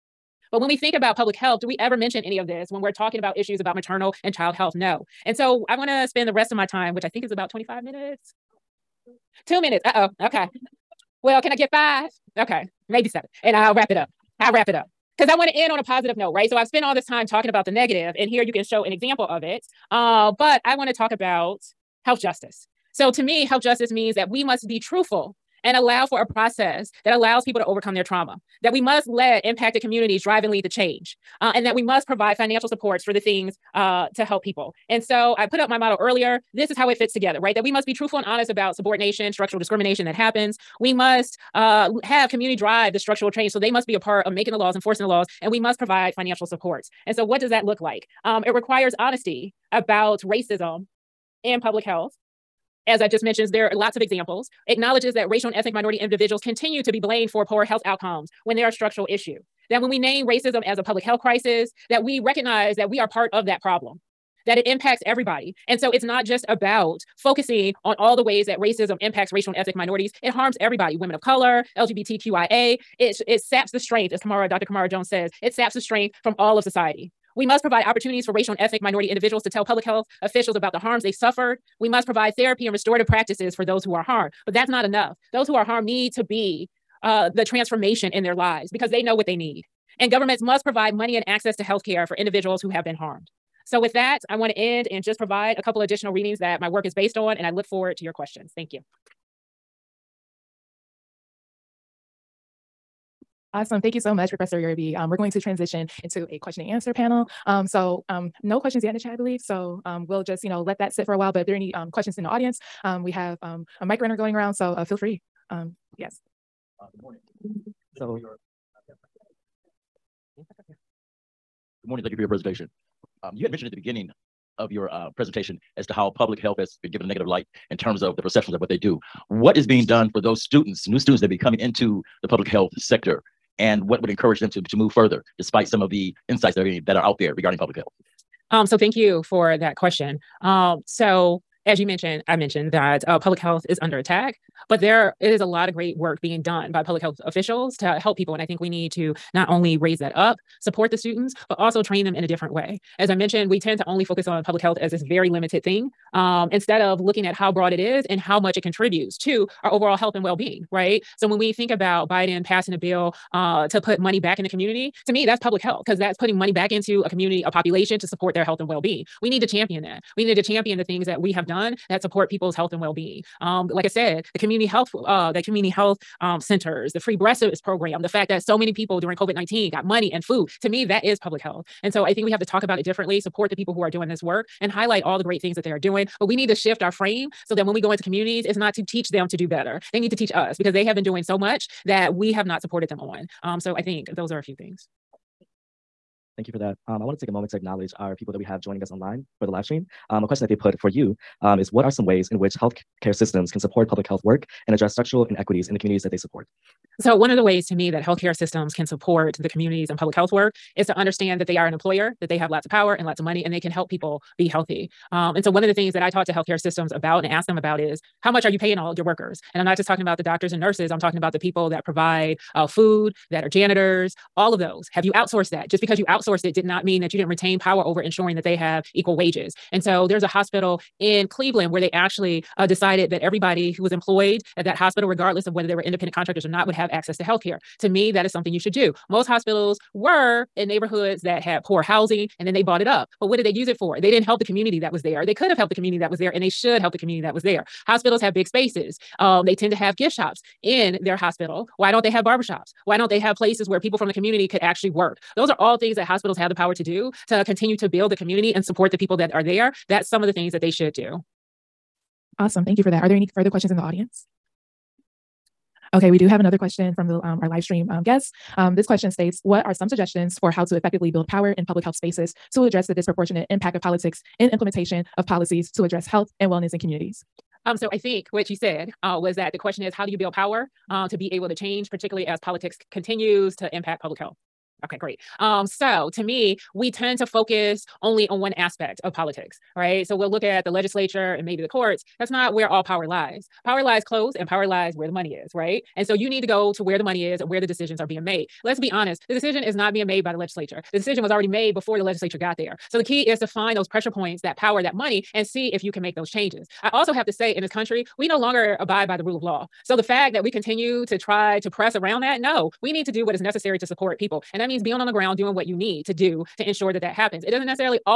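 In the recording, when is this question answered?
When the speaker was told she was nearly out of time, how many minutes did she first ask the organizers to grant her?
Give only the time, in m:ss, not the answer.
0:11.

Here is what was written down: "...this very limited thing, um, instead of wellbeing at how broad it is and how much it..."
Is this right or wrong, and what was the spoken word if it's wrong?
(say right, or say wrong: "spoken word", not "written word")
wrong: "looking", not "wellbeing".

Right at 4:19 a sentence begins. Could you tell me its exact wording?
That's some of the things that they should do.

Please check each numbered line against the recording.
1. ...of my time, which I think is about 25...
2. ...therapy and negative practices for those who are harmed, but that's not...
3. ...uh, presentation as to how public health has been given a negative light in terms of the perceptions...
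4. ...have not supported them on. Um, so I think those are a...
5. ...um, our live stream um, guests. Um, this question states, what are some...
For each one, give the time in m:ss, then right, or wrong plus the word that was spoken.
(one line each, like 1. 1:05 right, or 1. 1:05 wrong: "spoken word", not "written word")
1. 0:06 right
2. 1:22 wrong: "restorative", not "negative"
3. 2:04 right
4. 3:12 right
5. 4:27 right.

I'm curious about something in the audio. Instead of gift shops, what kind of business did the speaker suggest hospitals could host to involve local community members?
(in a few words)
barbershops.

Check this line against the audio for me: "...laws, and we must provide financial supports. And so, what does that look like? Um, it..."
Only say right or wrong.
right.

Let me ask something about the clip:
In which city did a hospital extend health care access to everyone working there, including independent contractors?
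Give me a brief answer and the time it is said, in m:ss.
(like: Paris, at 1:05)
Cleveland, at 3:51.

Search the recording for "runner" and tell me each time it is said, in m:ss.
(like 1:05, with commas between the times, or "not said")
1:53.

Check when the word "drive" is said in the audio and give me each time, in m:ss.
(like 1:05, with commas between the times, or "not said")
0:30, 0:42.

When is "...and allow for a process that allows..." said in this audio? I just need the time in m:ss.
0:25.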